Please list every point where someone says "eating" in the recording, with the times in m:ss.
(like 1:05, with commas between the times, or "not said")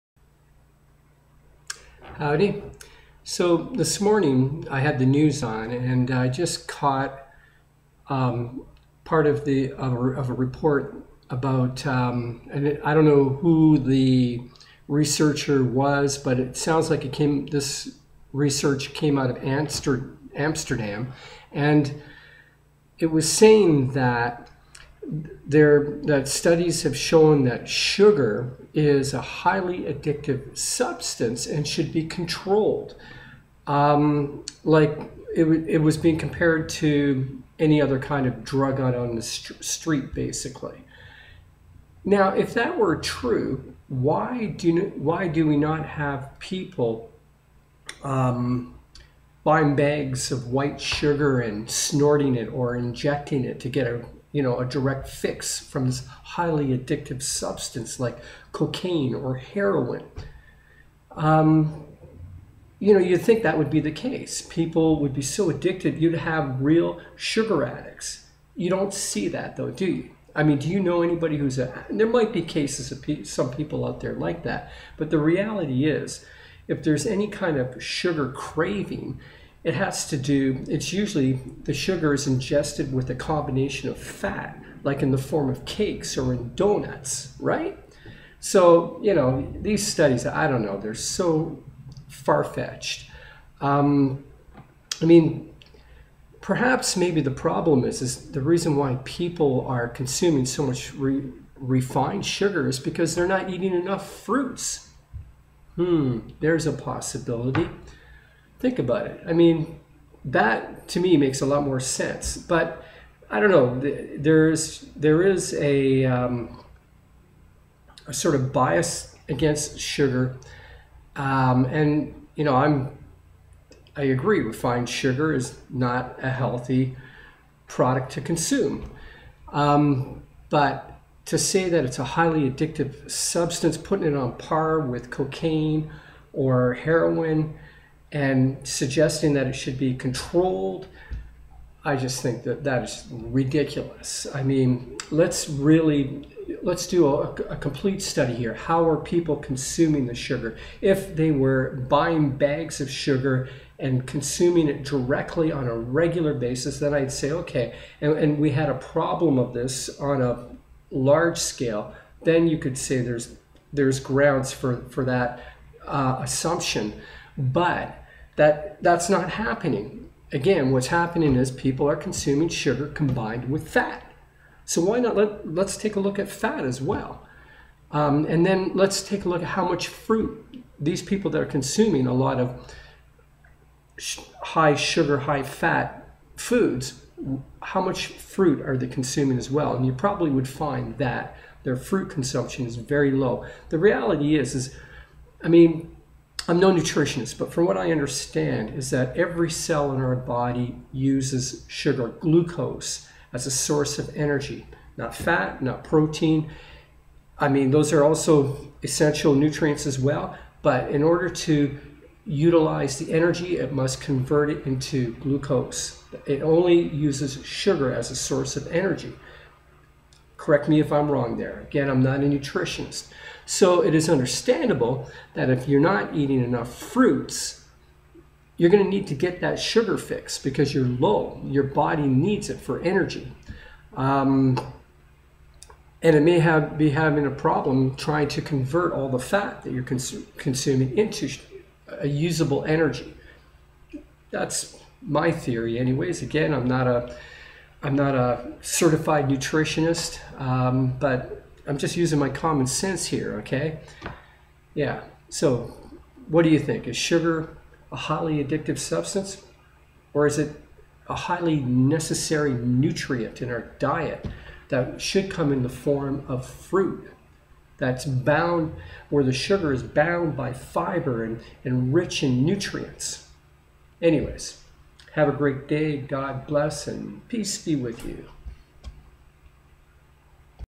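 1:43, 3:46.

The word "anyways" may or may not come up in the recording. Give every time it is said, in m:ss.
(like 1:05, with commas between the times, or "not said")
4:05, 4:34.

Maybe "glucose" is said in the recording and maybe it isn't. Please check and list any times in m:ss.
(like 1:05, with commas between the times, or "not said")
3:22, 3:35.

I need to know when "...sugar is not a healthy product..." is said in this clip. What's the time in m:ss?
2:04.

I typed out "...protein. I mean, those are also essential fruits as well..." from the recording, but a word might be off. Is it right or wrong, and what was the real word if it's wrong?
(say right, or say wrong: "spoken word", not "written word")
wrong: "nutrients", not "fruits".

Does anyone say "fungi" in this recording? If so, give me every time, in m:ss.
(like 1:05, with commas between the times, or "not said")
not said.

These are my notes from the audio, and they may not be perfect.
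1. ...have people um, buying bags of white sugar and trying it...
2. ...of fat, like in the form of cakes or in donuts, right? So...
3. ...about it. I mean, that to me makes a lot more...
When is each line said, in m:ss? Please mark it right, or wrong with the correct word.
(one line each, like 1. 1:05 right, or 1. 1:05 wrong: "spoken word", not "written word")
1. 0:45 wrong: "snorting", not "trying"
2. 1:23 right
3. 1:48 right.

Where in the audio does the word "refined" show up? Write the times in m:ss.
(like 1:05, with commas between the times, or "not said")
1:41, 2:04.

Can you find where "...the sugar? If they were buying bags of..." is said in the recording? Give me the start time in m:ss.
2:30.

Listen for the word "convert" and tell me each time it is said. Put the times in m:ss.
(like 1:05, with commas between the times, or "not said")
3:34, 3:58.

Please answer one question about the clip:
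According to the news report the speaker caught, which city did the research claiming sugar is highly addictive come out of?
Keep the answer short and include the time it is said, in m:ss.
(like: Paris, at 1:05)
Amsterdam, at 0:20.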